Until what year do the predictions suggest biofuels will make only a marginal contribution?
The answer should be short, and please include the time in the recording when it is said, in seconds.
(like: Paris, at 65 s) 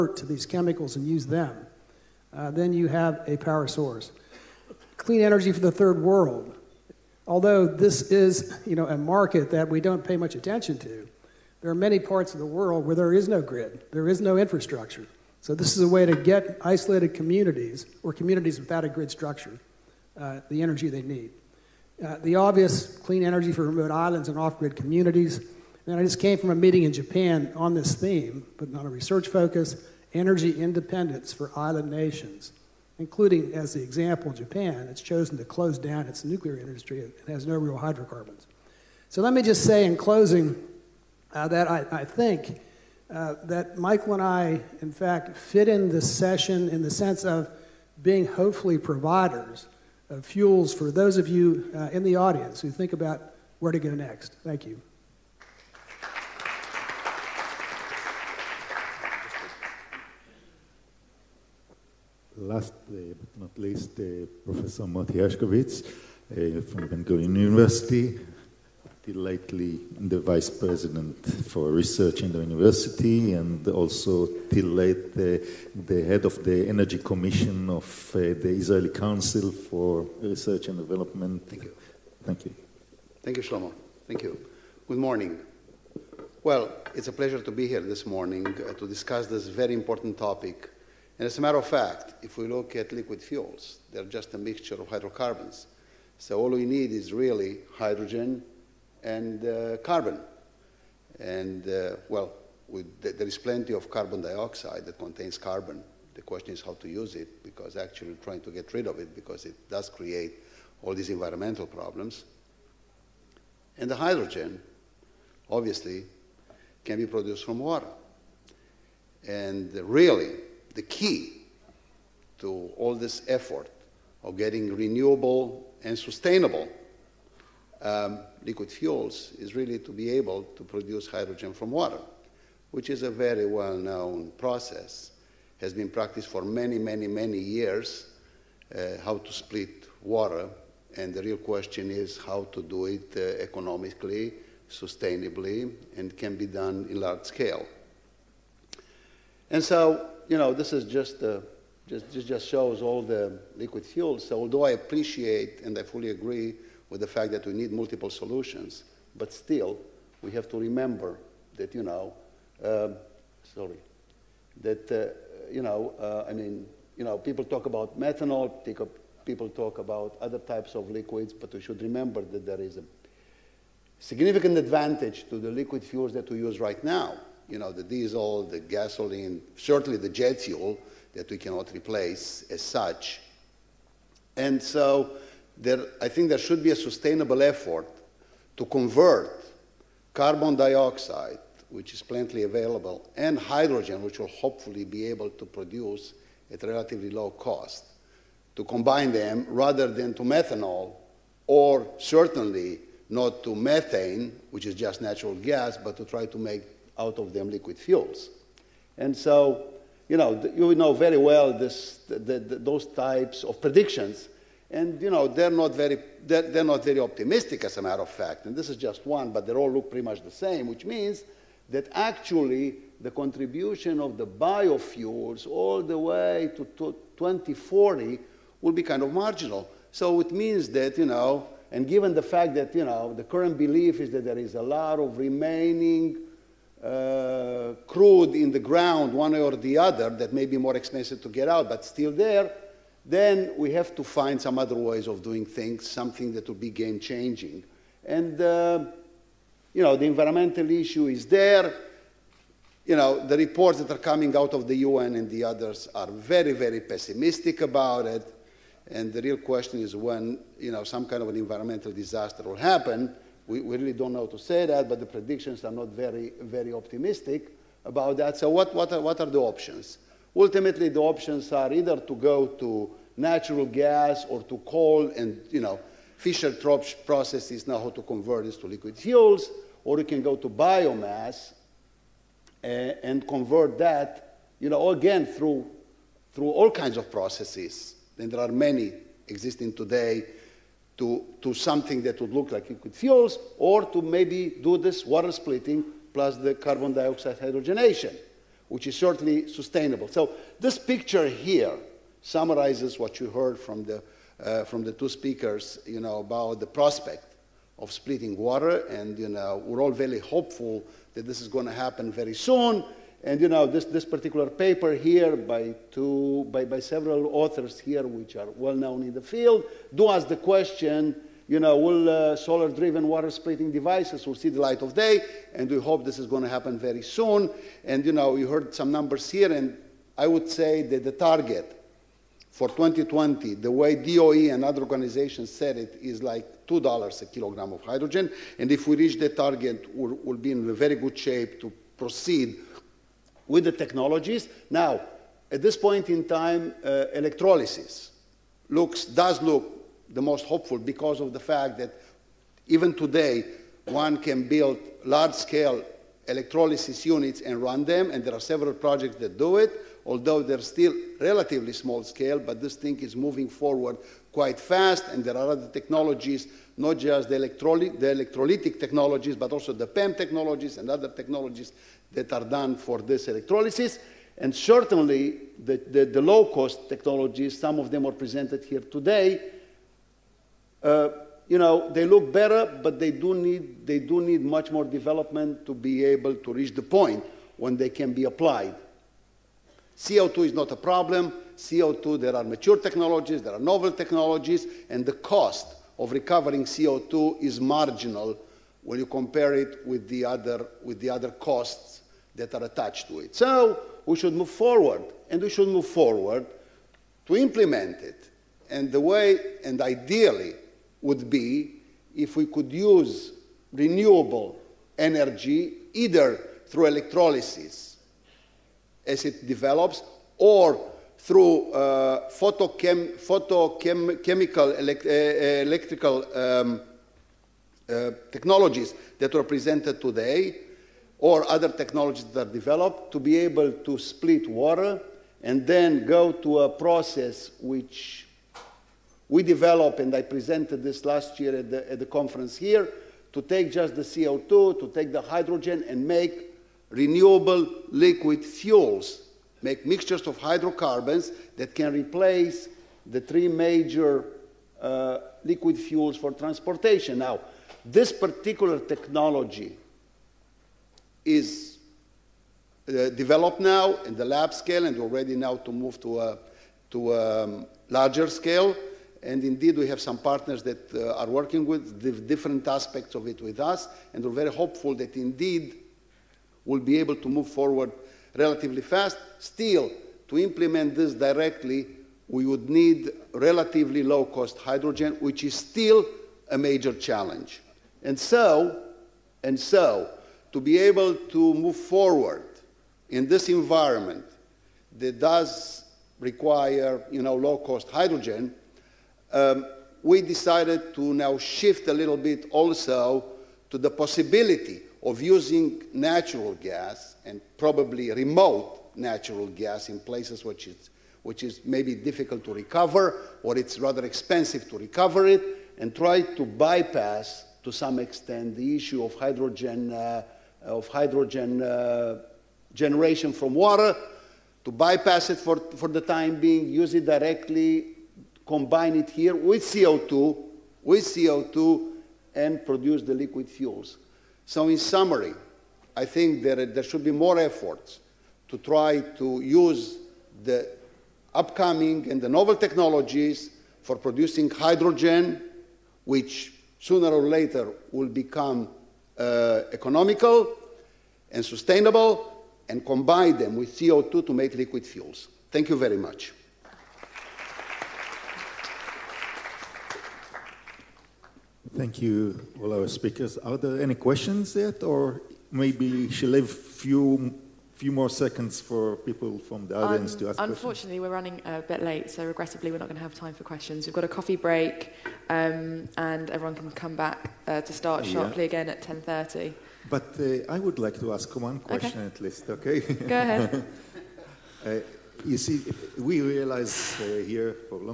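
2040, at 227 s.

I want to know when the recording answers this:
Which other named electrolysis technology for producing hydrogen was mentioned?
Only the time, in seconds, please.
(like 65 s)
369 s.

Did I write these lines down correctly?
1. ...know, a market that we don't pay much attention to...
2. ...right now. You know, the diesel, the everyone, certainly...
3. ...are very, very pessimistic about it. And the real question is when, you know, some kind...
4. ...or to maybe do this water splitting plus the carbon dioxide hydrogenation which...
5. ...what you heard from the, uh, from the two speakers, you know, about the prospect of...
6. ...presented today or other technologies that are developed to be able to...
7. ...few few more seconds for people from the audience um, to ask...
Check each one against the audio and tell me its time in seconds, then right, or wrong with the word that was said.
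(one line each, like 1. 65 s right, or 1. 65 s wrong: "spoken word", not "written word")
1. 8 s right
2. 176 s wrong: "gasoline", not "everyone"
3. 255 s right
4. 293 s right
5. 303 s right
6. 429 s right
7. 566 s right.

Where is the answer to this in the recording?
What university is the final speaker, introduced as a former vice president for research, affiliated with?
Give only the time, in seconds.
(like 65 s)
66 s.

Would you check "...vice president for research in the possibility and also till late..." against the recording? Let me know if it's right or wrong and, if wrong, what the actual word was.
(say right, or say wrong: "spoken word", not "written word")
wrong: "university", not "possibility".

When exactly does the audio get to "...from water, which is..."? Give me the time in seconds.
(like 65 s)
131 s.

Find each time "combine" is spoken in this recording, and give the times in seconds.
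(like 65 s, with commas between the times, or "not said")
198 s, 528 s, 552 s.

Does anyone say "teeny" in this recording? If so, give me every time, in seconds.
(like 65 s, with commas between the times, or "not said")
not said.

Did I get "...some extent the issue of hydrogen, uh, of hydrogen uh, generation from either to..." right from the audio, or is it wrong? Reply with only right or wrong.
wrong.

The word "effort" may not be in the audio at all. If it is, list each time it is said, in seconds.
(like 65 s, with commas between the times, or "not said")
123 s, 187 s, 537 s.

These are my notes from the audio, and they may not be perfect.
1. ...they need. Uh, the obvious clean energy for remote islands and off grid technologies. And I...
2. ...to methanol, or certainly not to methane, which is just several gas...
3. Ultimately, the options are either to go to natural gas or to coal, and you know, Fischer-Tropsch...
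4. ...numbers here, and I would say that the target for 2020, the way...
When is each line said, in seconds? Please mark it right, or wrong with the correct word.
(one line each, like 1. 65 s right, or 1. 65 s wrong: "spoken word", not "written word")
1. 20 s wrong: "communities", not "technologies"
2. 200 s wrong: "natural", not "several"
3. 270 s right
4. 328 s right.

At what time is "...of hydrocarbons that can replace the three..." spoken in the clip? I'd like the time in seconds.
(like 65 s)
450 s.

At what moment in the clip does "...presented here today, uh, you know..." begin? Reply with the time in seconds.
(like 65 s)
378 s.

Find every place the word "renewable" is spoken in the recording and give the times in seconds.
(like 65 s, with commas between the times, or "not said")
124 s, 413 s, 446 s.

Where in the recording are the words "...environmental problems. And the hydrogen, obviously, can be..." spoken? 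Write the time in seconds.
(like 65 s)
111 s.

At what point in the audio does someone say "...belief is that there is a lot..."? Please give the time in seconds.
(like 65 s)
233 s.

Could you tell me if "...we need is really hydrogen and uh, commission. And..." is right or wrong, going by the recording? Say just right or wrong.
wrong.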